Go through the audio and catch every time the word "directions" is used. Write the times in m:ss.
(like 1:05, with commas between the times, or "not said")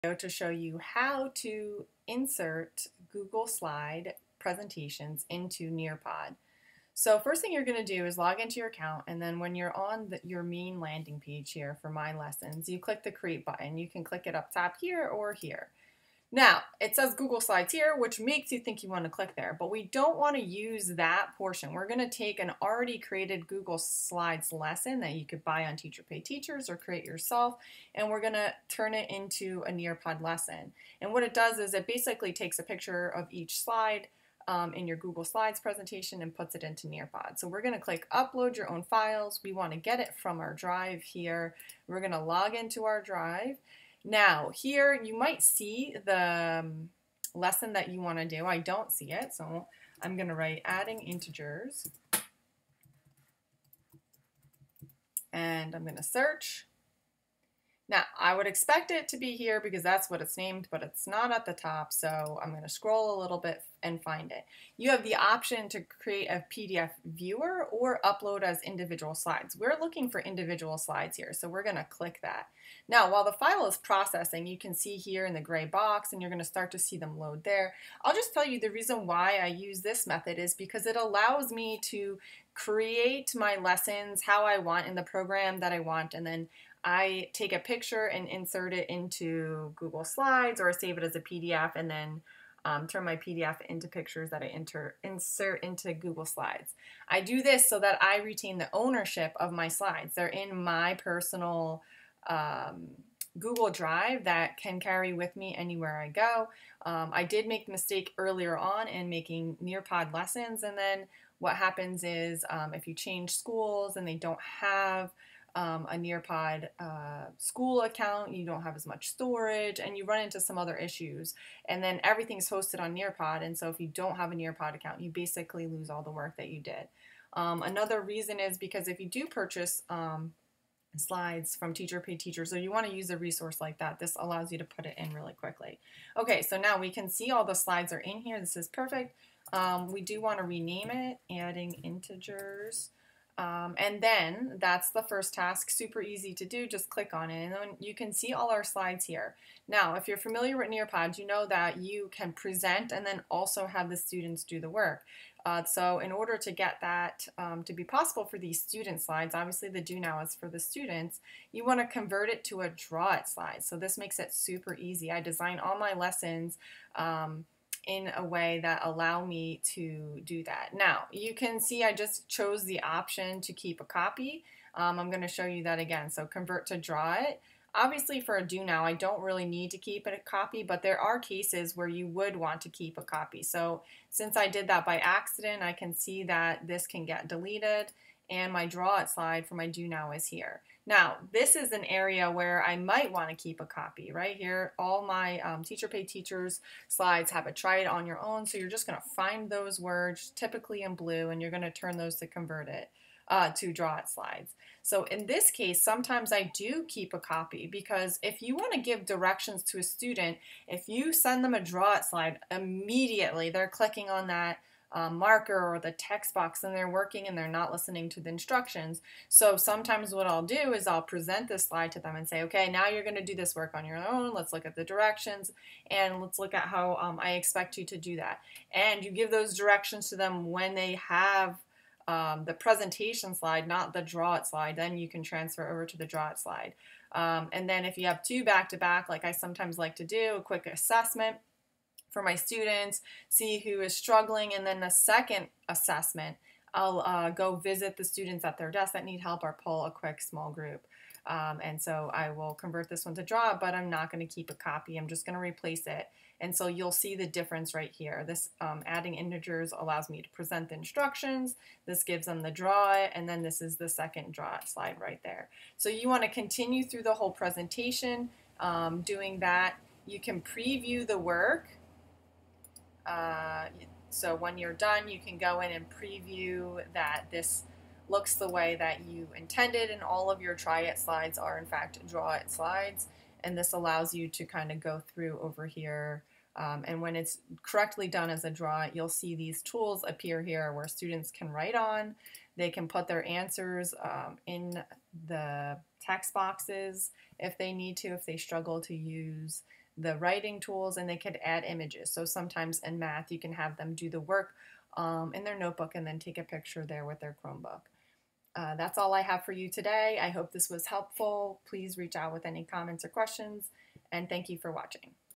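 3:29, 3:44, 3:49.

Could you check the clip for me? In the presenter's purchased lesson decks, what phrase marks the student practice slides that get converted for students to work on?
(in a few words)
try it on your own.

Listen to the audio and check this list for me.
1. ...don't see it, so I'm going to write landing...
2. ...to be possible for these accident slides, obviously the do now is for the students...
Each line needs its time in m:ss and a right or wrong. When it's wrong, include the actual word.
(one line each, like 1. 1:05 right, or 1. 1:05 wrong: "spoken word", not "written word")
1. 0:48 wrong: "adding", not "landing"
2. 2:37 wrong: "student", not "accident".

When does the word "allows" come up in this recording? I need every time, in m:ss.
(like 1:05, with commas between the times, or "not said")
1:20, 2:14, 2:48, 4:19, 4:43.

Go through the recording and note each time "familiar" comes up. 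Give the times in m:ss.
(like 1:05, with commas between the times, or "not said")
2:30.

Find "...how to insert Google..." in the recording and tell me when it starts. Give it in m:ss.
0:00.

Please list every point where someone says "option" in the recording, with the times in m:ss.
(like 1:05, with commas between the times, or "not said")
1:05, 2:52.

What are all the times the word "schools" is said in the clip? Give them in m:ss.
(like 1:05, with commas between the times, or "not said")
1:53, 1:57.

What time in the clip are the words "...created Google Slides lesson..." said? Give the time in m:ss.
0:22.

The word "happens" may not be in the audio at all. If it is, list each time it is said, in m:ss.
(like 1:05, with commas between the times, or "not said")
1:51.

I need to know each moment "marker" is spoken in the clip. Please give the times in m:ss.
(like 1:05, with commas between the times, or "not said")
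3:35.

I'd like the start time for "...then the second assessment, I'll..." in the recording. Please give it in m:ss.
4:04.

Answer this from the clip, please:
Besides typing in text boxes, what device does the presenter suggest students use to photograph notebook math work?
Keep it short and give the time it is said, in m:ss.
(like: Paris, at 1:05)
Chromebook, at 5:07.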